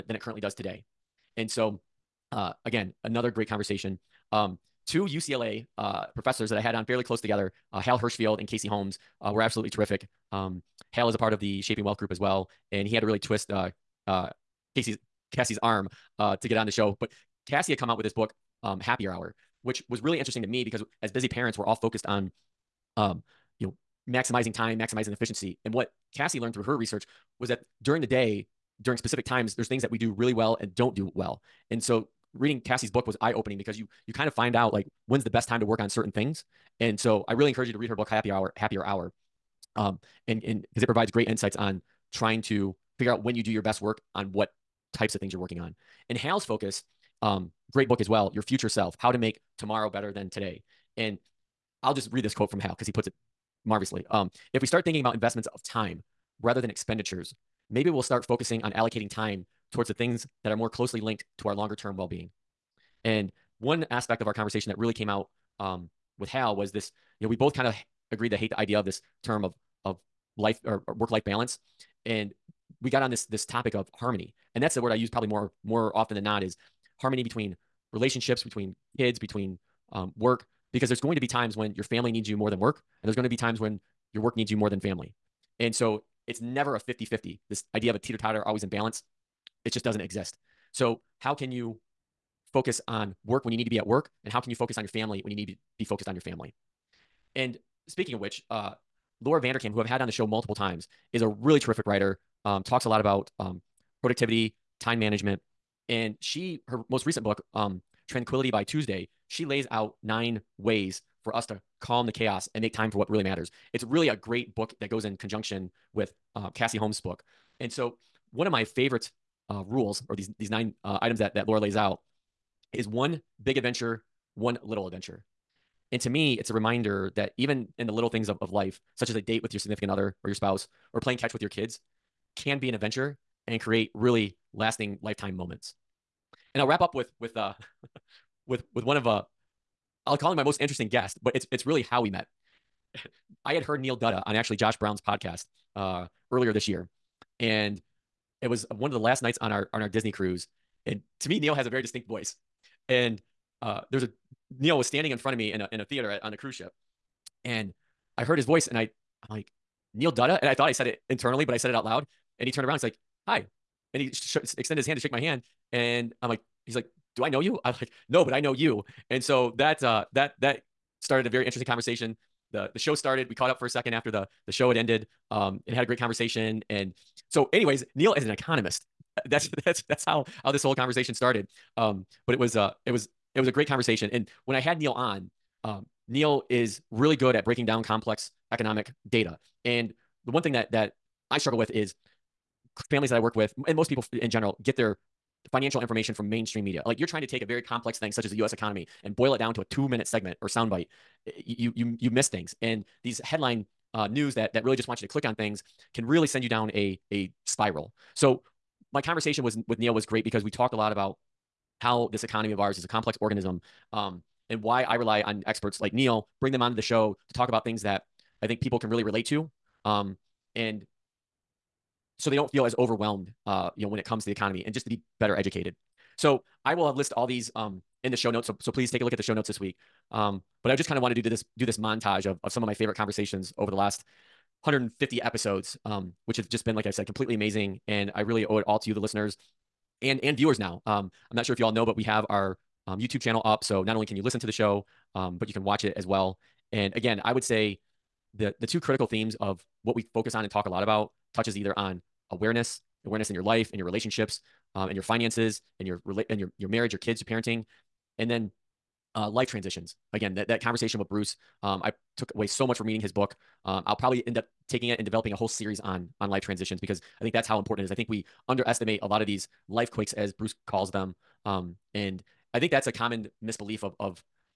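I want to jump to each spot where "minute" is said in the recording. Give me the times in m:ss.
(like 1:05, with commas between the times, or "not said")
3:19.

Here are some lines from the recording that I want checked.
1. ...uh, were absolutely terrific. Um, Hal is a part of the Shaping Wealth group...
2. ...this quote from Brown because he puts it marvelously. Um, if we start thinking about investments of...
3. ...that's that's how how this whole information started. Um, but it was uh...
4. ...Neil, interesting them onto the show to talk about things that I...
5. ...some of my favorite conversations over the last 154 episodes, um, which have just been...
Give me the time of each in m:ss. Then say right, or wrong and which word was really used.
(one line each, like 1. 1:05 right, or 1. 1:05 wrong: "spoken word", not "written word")
1. 0:09 right
2. 0:52 wrong: "Hal", not "Brown"
3. 2:59 wrong: "conversation", not "information"
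4. 3:35 wrong: "bring", not "interesting"
5. 3:52 wrong: "150", not "154".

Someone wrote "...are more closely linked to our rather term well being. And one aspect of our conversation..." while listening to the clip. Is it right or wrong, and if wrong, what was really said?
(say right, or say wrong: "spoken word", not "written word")
wrong: "longer", not "rather".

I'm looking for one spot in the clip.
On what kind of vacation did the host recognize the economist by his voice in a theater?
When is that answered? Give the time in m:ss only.
2:29.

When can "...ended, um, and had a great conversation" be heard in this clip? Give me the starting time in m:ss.
2:54.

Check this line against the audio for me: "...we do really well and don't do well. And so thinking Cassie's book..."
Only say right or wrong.
wrong.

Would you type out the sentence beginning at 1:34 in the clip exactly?
And how can you focus on your family when you need to be, be focused on your family?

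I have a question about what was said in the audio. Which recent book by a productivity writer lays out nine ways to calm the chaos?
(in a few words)
Tranquility by Tuesday.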